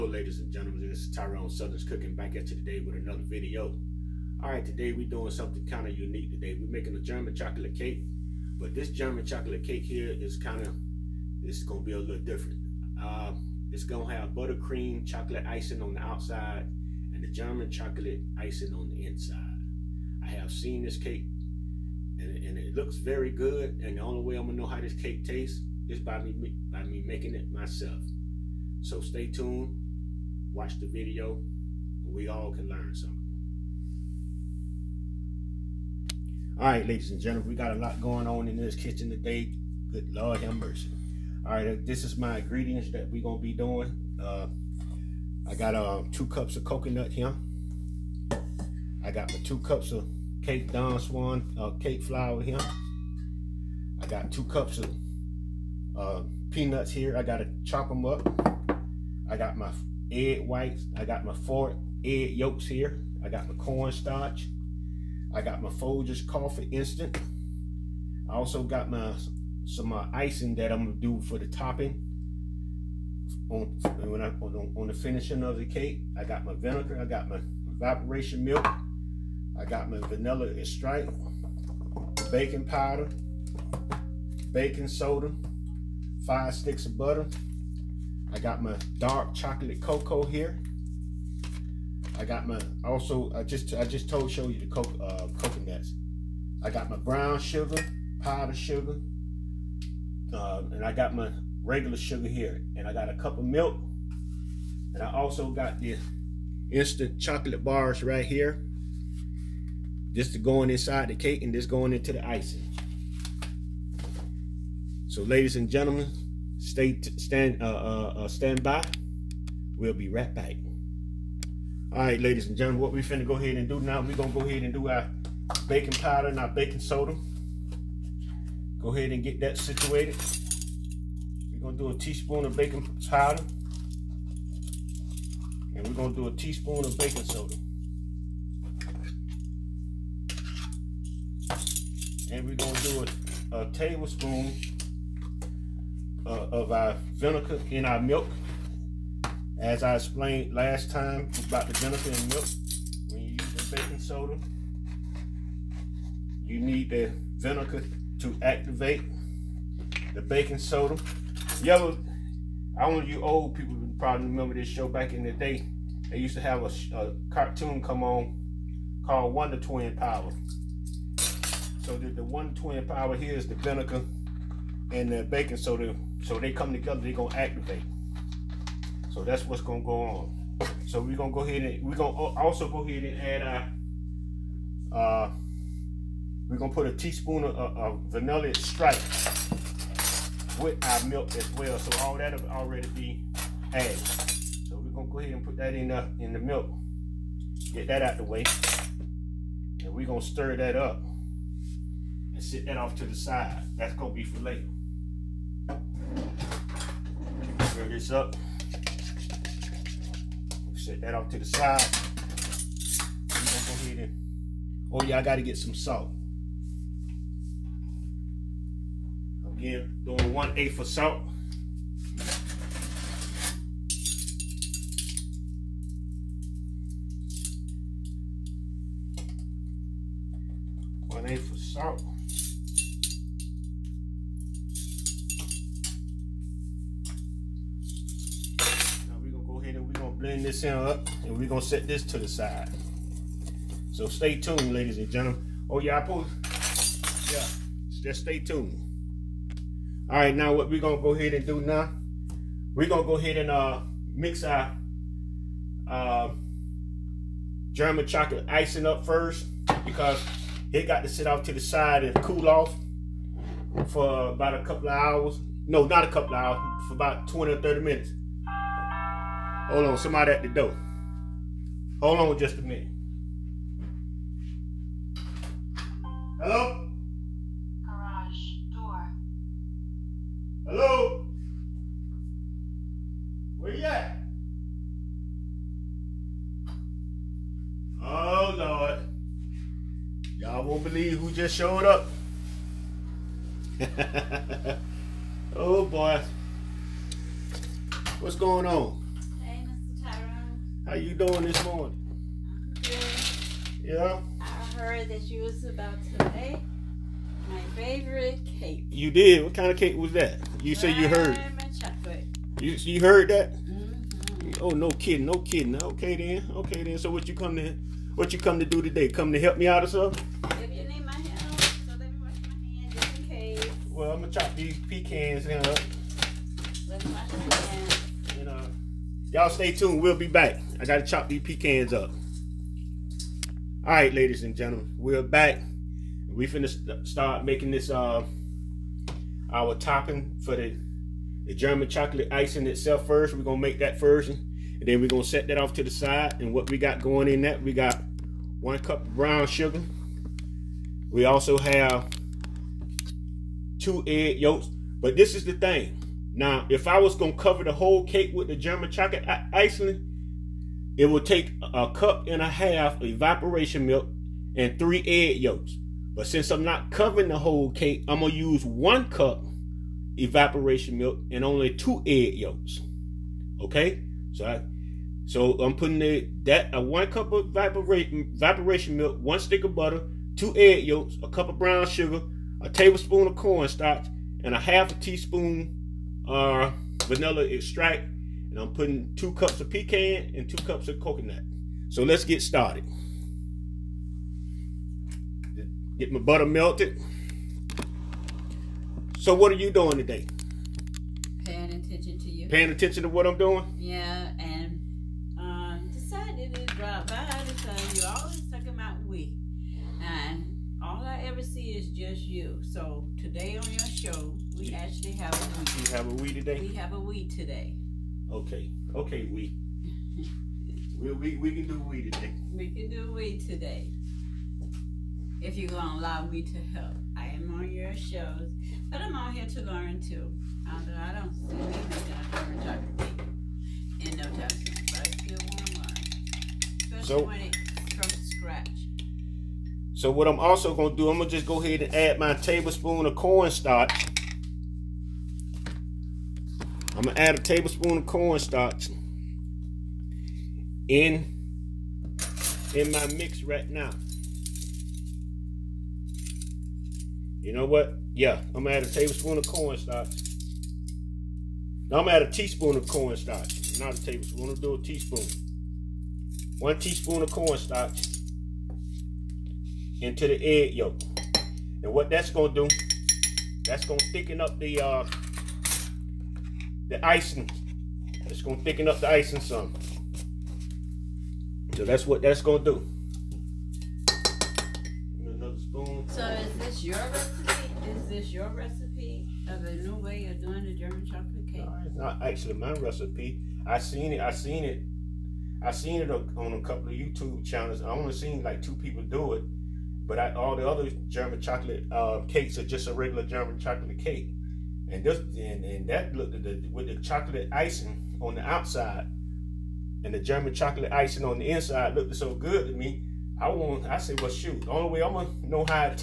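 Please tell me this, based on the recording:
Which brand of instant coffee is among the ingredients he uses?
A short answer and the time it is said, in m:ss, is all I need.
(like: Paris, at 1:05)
Folgers, at 1:05.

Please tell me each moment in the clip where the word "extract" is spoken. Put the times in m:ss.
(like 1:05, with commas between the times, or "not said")
1:20, 3:08, 6:27.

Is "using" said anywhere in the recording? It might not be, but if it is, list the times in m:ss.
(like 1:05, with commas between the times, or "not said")
2:33.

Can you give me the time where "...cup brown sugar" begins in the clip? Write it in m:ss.
5:48.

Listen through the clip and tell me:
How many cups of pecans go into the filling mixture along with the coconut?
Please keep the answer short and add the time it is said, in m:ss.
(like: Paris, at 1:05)
2 cups, at 6:29.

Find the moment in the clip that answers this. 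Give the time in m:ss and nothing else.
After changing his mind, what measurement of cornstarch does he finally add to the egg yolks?
7:46.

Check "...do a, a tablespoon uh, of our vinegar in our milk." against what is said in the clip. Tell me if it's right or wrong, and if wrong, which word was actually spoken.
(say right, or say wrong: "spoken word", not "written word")
right.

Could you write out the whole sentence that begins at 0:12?
Uh, it's going to have buttercream chocolate icing on the outside and the German chocolate icing on the inside.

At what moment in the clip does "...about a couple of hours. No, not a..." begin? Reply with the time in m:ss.
4:24.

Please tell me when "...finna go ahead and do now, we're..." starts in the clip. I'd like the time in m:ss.
2:03.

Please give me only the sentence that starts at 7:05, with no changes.
If you're gonna allow me to help, I am on your shows, but I'm out here to learn too.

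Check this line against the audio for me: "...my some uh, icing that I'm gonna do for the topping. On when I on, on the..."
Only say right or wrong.
right.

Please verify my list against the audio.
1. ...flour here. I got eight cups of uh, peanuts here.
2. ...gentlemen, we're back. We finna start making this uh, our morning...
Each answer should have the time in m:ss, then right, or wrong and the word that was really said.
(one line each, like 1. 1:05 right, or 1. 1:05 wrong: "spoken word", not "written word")
1. 0:52 wrong: "two", not "eight"
2. 5:34 wrong: "topping", not "morning".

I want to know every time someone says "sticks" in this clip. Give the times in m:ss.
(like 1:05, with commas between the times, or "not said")
1:26, 6:19.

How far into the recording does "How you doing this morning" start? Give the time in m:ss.
5:00.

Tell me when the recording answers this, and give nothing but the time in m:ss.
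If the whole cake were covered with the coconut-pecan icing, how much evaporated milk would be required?
6:01.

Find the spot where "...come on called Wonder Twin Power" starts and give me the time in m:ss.
2:47.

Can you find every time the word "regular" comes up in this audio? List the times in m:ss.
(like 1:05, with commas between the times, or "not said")
1:41, 8:22.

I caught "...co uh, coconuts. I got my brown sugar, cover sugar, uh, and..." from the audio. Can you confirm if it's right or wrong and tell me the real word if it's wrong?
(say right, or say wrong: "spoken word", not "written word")
wrong: "powder", not "cover".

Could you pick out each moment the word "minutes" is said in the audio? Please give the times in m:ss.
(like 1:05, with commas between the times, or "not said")
4:27, 4:32.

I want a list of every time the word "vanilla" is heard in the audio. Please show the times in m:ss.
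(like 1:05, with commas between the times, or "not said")
1:20, 3:08, 6:27.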